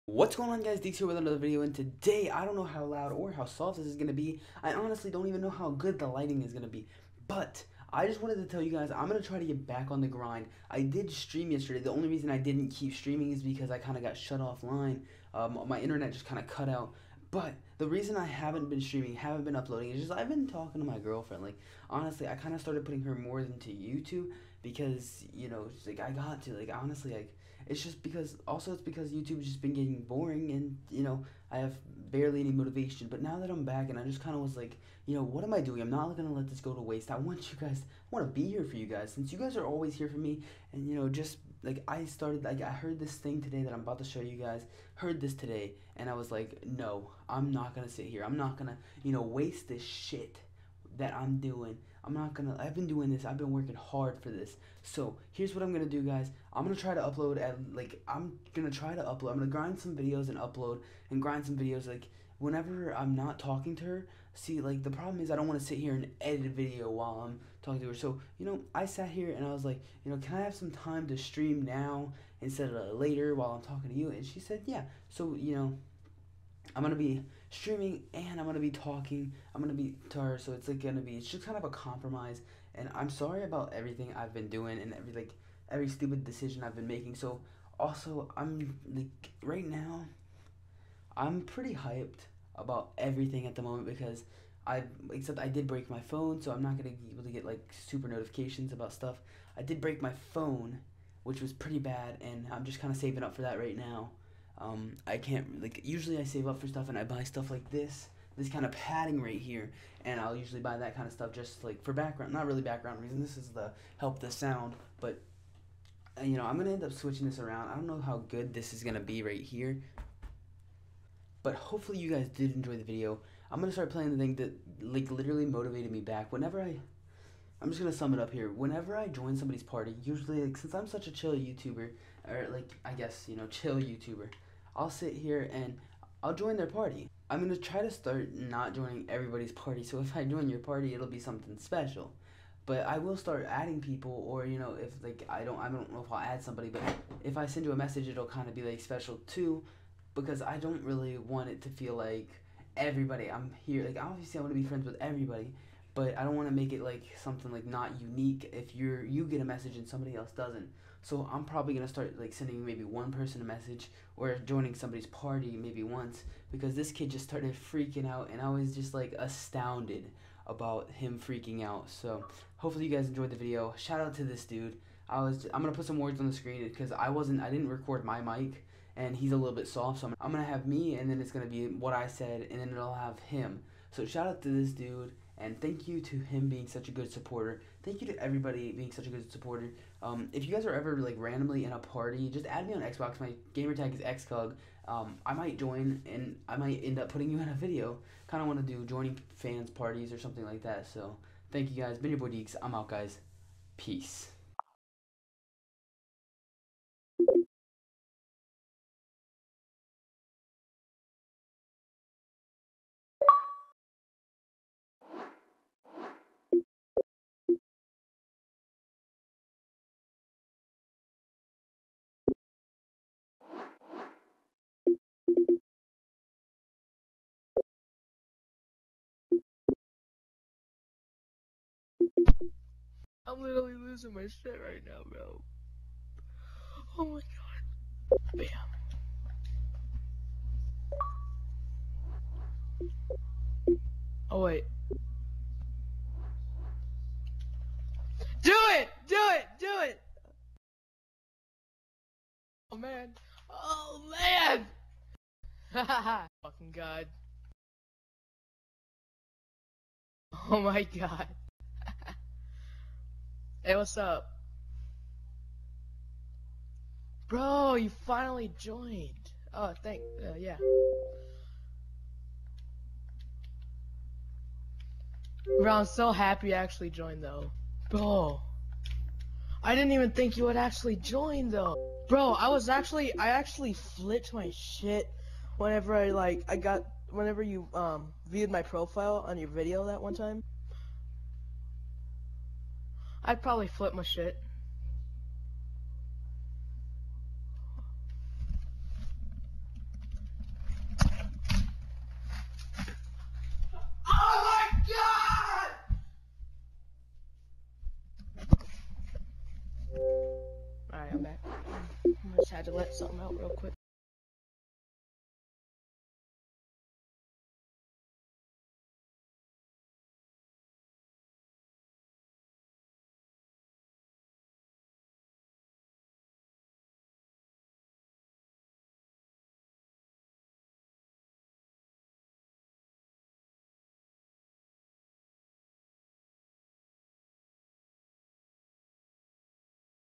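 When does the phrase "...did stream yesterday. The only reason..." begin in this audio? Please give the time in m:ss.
0:10.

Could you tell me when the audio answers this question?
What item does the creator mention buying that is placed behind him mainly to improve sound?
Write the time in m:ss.
1:48.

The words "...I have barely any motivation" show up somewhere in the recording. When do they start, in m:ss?
0:31.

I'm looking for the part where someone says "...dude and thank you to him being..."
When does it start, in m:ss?
3:04.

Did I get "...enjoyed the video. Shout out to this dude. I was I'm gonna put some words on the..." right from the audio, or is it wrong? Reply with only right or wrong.
right.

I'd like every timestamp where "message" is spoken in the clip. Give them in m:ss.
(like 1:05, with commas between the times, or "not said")
2:27, 2:39, 2:43.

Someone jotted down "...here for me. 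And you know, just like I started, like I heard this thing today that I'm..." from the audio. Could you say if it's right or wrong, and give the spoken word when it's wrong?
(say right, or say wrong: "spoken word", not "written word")
right.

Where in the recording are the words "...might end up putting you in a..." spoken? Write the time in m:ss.
3:16.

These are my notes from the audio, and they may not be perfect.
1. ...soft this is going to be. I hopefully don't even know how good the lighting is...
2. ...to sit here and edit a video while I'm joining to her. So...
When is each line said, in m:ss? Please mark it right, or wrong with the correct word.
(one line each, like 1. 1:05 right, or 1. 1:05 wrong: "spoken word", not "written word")
1. 0:03 wrong: "honestly", not "hopefully"
2. 1:05 wrong: "talking", not "joining".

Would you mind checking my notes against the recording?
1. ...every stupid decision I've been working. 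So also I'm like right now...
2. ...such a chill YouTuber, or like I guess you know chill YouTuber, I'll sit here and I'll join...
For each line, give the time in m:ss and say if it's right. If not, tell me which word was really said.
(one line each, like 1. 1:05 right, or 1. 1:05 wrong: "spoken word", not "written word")
1. 1:25 wrong: "making", not "working"
2. 2:10 right.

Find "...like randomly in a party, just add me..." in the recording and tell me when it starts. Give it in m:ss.
3:10.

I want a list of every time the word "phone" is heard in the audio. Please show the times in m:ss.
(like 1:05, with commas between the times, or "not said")
1:35, 1:40.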